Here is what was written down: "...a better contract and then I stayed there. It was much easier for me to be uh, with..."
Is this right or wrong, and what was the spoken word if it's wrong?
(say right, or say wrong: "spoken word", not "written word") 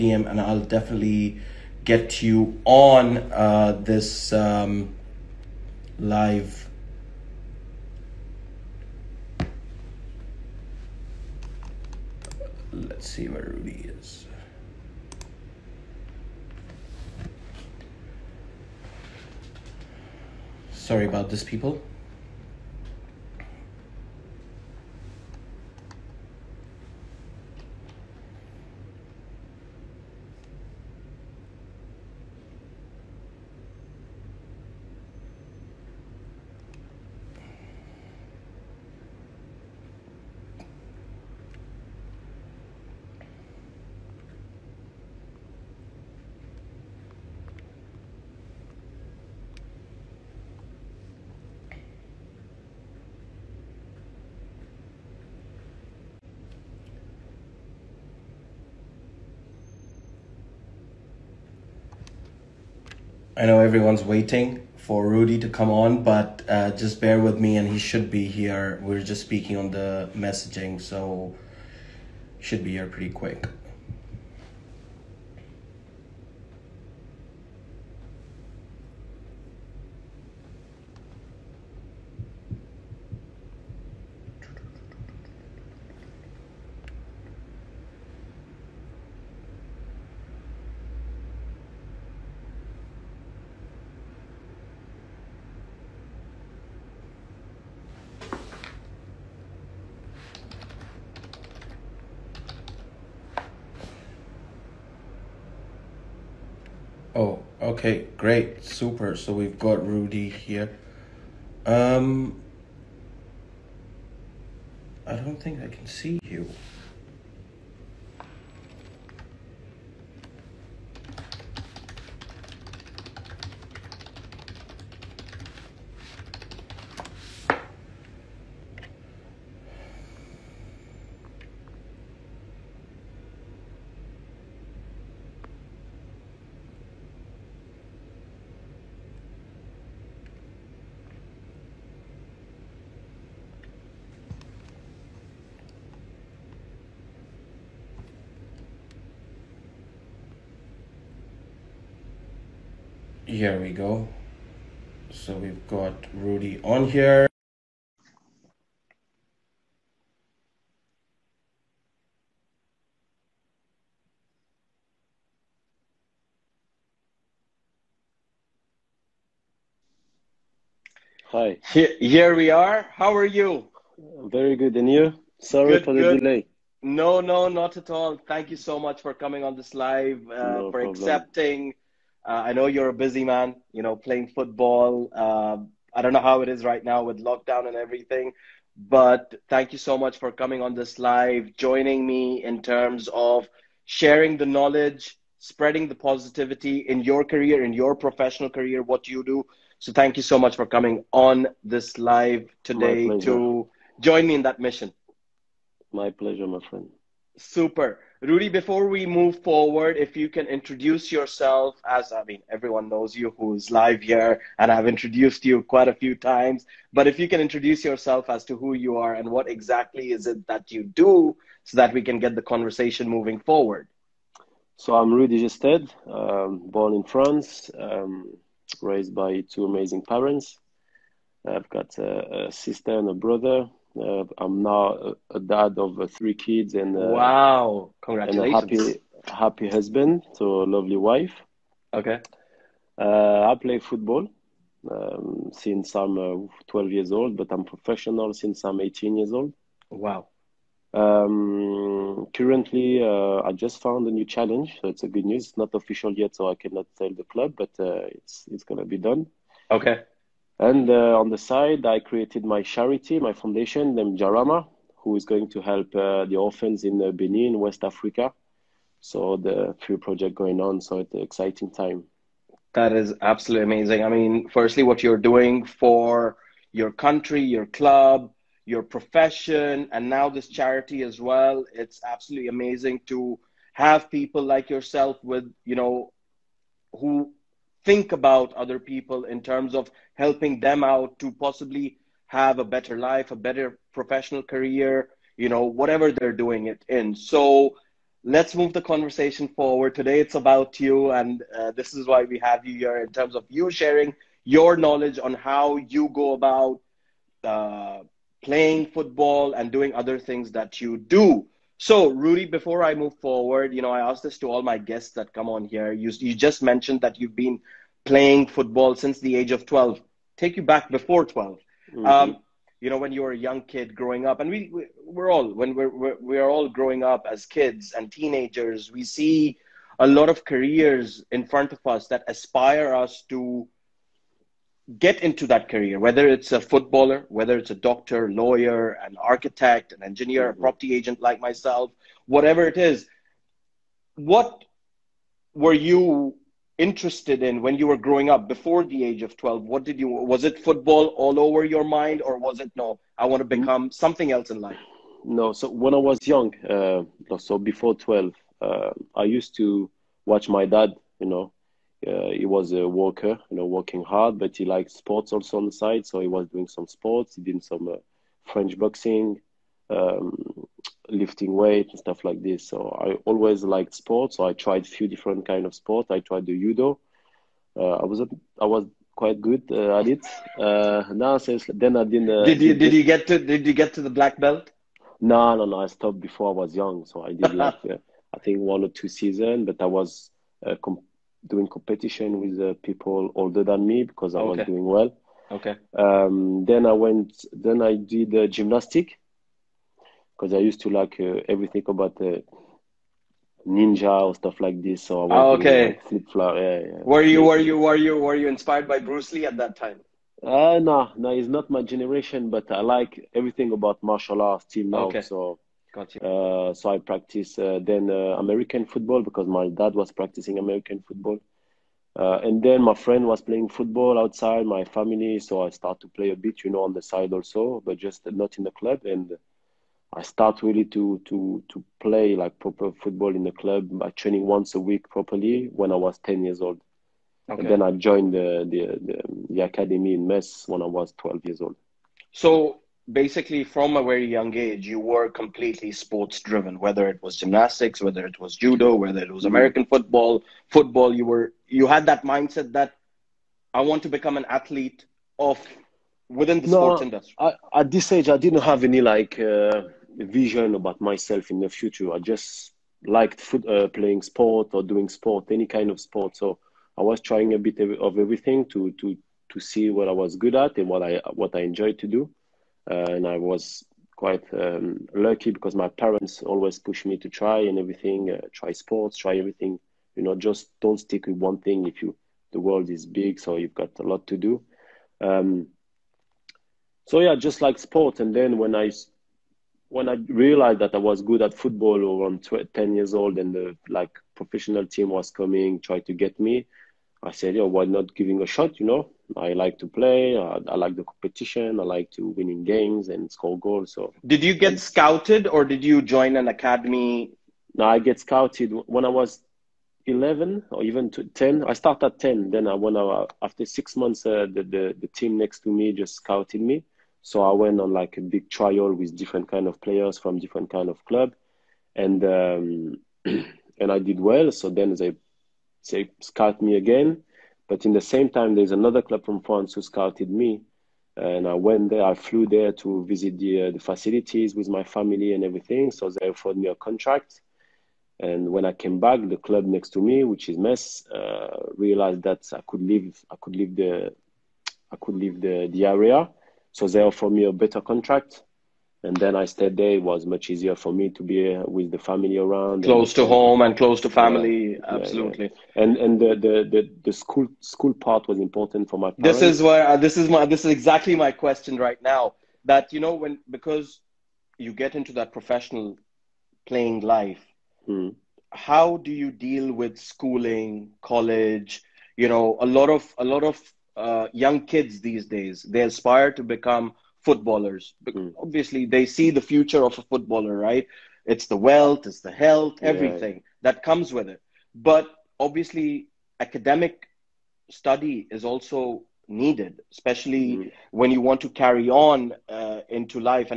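right.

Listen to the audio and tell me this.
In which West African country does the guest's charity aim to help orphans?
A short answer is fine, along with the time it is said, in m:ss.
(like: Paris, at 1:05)
Benin, at 4:27.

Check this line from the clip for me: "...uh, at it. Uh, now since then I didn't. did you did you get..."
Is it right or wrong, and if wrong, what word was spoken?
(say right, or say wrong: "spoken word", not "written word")
right.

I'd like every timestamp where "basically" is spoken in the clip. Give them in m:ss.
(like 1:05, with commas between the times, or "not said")
7:23.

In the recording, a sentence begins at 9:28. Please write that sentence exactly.
how do you deal with schooling, college?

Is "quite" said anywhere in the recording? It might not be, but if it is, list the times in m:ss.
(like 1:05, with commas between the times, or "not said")
3:35, 6:19, 7:54.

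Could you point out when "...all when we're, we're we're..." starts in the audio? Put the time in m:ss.
5:25.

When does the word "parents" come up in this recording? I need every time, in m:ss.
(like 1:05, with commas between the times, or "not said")
3:50, 7:55, 9:19.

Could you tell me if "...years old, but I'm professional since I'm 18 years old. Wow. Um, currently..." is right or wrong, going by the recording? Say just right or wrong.
right.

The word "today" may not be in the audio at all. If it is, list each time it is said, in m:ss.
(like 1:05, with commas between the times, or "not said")
3:22, 4:59.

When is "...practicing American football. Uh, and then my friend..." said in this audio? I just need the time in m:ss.
7:00.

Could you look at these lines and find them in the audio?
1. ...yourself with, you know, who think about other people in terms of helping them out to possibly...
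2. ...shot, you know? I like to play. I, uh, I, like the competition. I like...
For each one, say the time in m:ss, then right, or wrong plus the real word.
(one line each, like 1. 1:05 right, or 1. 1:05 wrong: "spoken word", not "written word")
1. 4:44 right
2. 8:18 right.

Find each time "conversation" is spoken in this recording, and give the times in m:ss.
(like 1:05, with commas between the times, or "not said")
3:42, 4:58.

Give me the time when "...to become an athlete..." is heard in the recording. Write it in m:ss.
7:34.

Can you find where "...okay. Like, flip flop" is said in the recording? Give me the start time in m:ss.
6:45.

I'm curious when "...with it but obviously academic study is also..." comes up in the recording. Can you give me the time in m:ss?
9:44.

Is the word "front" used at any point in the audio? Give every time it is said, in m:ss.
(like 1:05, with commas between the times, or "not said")
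5:31.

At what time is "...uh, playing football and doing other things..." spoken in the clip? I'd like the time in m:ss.
5:07.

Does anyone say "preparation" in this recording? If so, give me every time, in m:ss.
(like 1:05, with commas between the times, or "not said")
not said.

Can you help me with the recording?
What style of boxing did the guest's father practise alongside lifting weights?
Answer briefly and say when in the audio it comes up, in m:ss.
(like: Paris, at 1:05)
French boxing, at 6:08.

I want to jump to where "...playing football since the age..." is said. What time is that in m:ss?
5:18.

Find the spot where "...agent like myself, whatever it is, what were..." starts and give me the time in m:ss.
5:40.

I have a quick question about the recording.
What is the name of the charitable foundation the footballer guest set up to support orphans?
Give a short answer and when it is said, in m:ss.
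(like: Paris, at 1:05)
Jarama, at 4:24.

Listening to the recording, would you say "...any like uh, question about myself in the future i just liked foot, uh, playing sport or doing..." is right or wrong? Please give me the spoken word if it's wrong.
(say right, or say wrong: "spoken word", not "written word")
wrong: "vision", not "question".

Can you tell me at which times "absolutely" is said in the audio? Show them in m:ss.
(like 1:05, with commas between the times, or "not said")
4:33, 4:42, 9:14.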